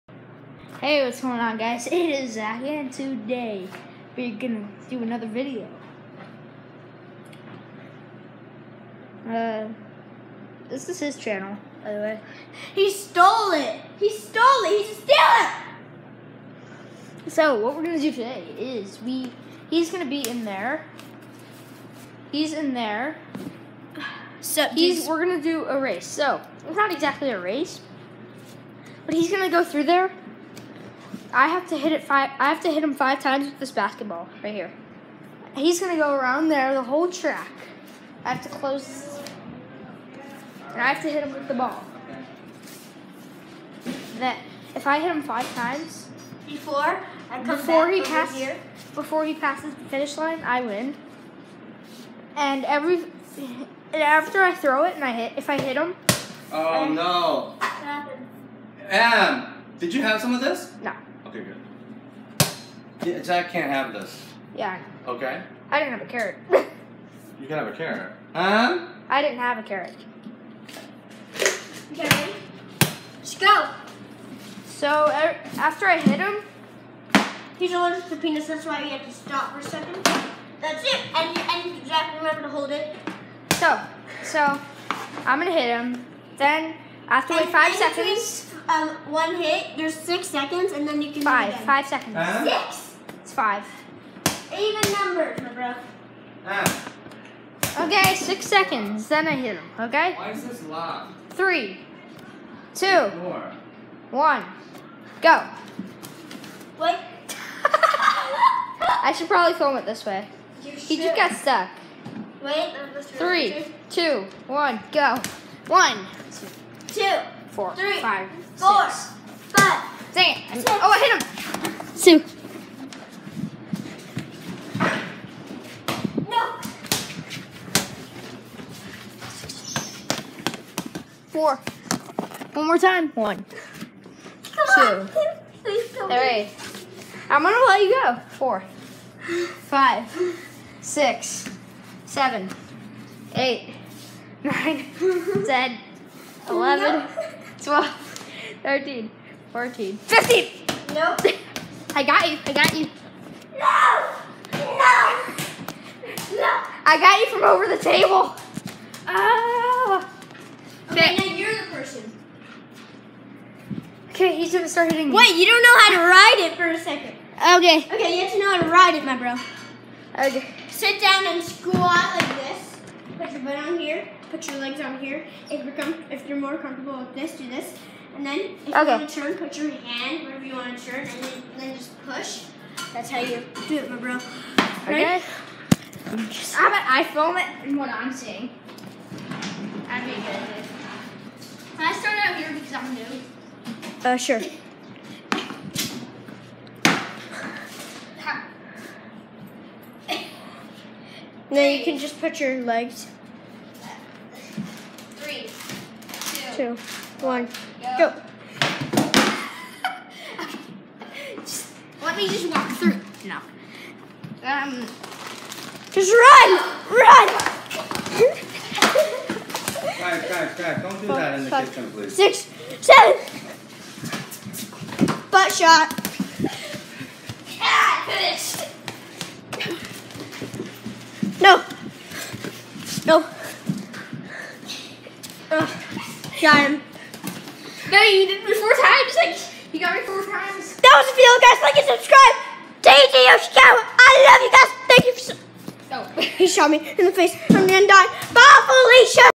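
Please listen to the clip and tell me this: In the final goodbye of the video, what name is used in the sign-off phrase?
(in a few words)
Felicia.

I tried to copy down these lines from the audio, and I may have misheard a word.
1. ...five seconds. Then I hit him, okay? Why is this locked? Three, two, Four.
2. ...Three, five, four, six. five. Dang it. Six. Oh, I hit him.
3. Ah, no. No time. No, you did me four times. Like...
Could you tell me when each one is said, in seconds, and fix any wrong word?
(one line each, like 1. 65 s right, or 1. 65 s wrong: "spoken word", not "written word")
1. 98 s wrong: "six", not "five"
2. 117 s right
3. 231 s right.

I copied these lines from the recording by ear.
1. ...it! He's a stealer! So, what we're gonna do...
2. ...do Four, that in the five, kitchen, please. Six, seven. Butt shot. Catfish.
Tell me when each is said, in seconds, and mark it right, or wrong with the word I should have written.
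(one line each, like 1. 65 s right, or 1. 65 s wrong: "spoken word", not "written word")
1. 14 s right
2. 221 s right.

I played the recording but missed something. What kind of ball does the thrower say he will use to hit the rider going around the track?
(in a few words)
basketball.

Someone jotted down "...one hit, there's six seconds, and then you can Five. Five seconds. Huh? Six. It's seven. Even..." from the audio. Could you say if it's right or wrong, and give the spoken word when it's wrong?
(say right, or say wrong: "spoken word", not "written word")
wrong: "five", not "seven".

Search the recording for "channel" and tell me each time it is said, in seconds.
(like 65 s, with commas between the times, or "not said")
11 s.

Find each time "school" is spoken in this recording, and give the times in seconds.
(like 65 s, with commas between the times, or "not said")
171 s.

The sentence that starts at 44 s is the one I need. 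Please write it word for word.
That if I hit him five times before before he passes before he passes the finish line, I win.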